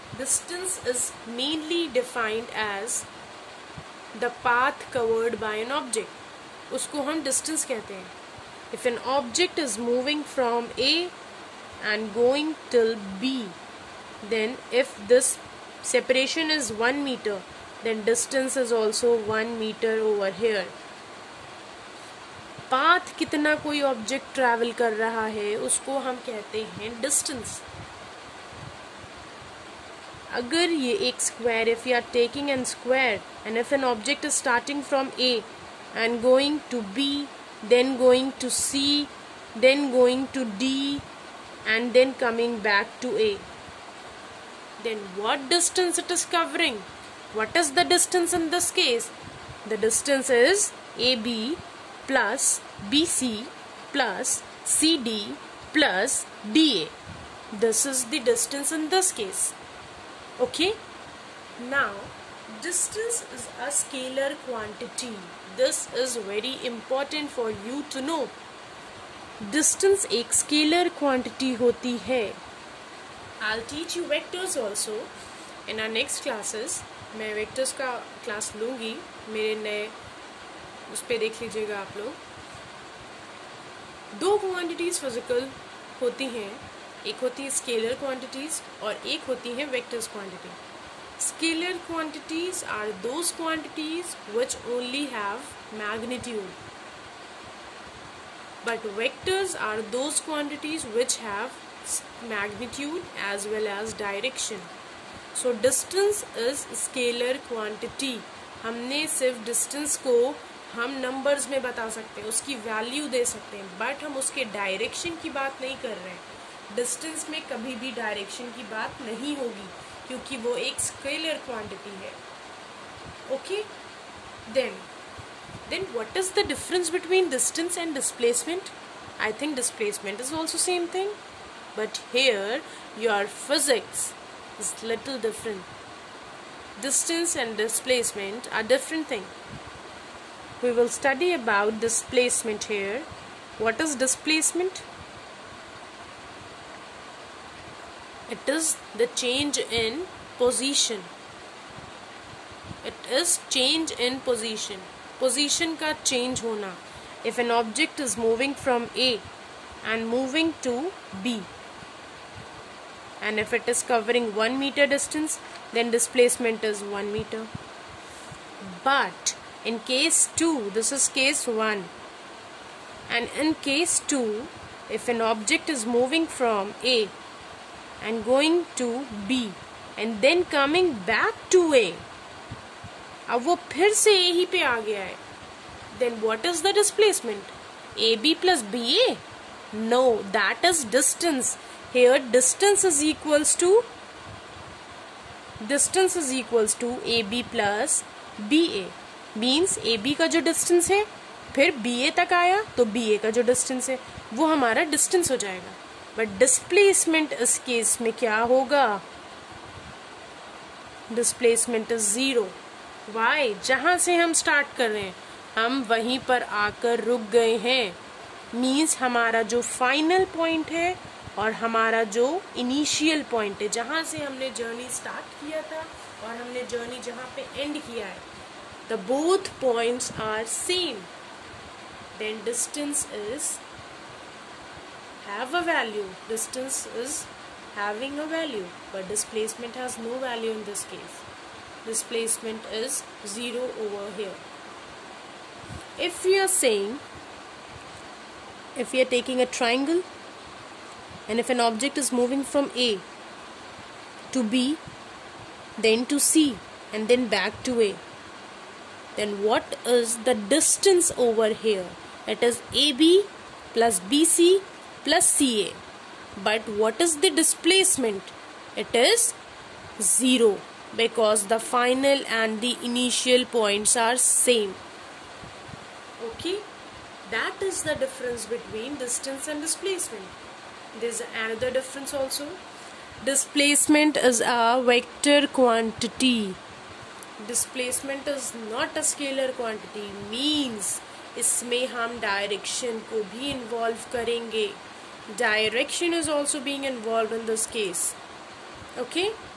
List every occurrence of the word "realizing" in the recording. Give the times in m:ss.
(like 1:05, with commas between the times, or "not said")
not said.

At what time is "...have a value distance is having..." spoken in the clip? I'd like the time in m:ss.
3:55.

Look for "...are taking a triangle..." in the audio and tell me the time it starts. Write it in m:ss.
4:09.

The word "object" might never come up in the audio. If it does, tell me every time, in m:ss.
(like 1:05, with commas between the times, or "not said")
0:33, 2:37, 2:55, 4:11.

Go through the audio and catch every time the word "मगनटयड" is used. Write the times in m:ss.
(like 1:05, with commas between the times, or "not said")
1:35, 1:42.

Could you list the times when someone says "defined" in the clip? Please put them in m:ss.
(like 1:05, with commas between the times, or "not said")
0:01.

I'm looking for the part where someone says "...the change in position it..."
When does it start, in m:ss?
2:28.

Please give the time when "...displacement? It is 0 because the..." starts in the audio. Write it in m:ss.
4:27.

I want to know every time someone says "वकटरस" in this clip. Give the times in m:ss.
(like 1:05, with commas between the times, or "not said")
1:29, 1:38.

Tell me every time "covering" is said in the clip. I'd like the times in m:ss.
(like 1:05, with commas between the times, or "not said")
0:46, 2:43.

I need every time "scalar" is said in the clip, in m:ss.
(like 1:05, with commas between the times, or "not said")
1:03, 1:10, 4:49.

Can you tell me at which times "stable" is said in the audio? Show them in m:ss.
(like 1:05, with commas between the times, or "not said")
not said.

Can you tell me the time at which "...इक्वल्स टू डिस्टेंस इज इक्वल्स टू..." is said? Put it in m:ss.
3:13.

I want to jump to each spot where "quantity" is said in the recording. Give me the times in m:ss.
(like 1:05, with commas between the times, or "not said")
1:04, 1:11, 4:45, 4:49.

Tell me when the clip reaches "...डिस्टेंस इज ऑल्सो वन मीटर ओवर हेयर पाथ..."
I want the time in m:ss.
0:18.